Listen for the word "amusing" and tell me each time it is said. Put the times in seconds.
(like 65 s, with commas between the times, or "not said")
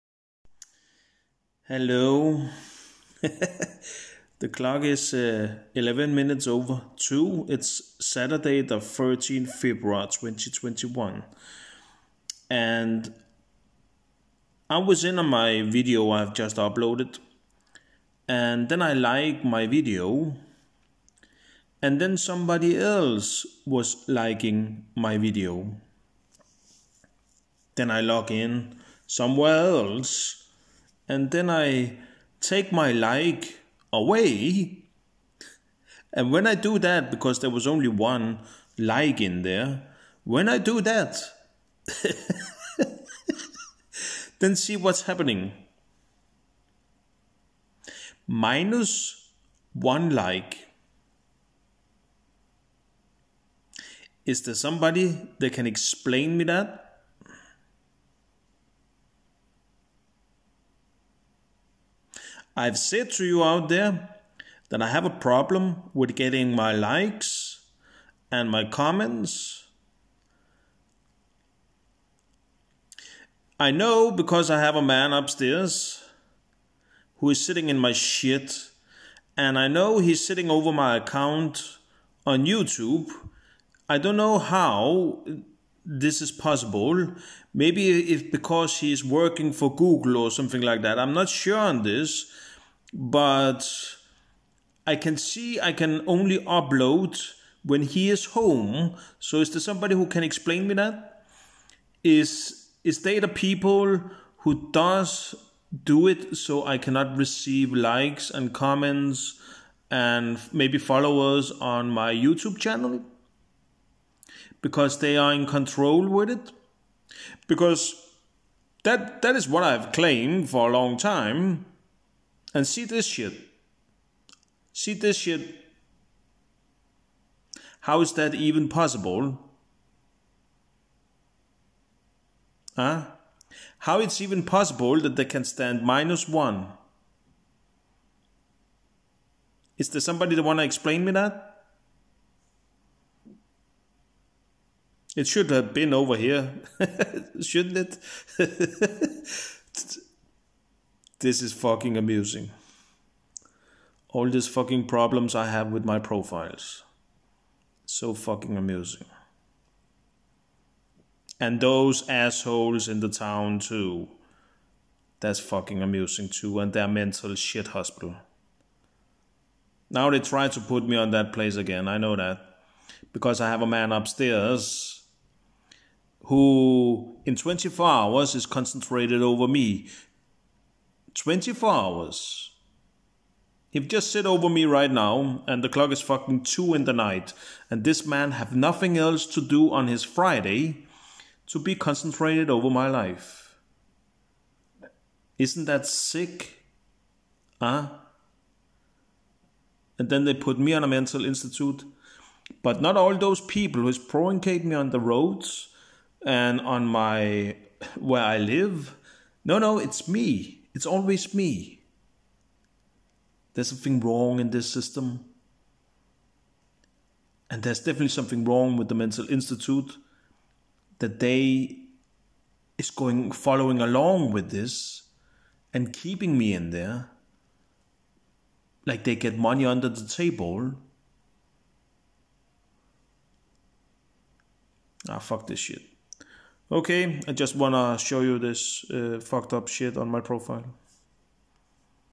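151 s, 158 s, 165 s.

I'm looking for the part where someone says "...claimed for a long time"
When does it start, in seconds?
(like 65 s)
119 s.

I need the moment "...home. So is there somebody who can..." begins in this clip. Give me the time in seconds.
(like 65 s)
98 s.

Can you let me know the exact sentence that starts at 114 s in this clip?
because they are in control with it.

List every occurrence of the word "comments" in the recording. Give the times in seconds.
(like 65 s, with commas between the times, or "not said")
68 s, 108 s.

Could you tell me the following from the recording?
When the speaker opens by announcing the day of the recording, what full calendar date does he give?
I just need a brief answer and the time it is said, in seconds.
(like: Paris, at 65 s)
13 February 2021, at 8 s.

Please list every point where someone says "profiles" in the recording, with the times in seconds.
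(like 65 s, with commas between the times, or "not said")
155 s, 240 s.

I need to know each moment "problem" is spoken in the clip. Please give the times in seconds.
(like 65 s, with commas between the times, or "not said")
65 s, 154 s.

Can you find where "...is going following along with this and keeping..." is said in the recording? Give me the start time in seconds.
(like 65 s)
222 s.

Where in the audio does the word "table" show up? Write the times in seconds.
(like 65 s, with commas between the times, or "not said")
230 s.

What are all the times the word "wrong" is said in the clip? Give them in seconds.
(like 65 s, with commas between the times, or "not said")
213 s, 218 s.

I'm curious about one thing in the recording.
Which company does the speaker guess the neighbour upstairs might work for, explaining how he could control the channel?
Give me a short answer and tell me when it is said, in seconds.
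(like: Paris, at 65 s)
Google, at 89 s.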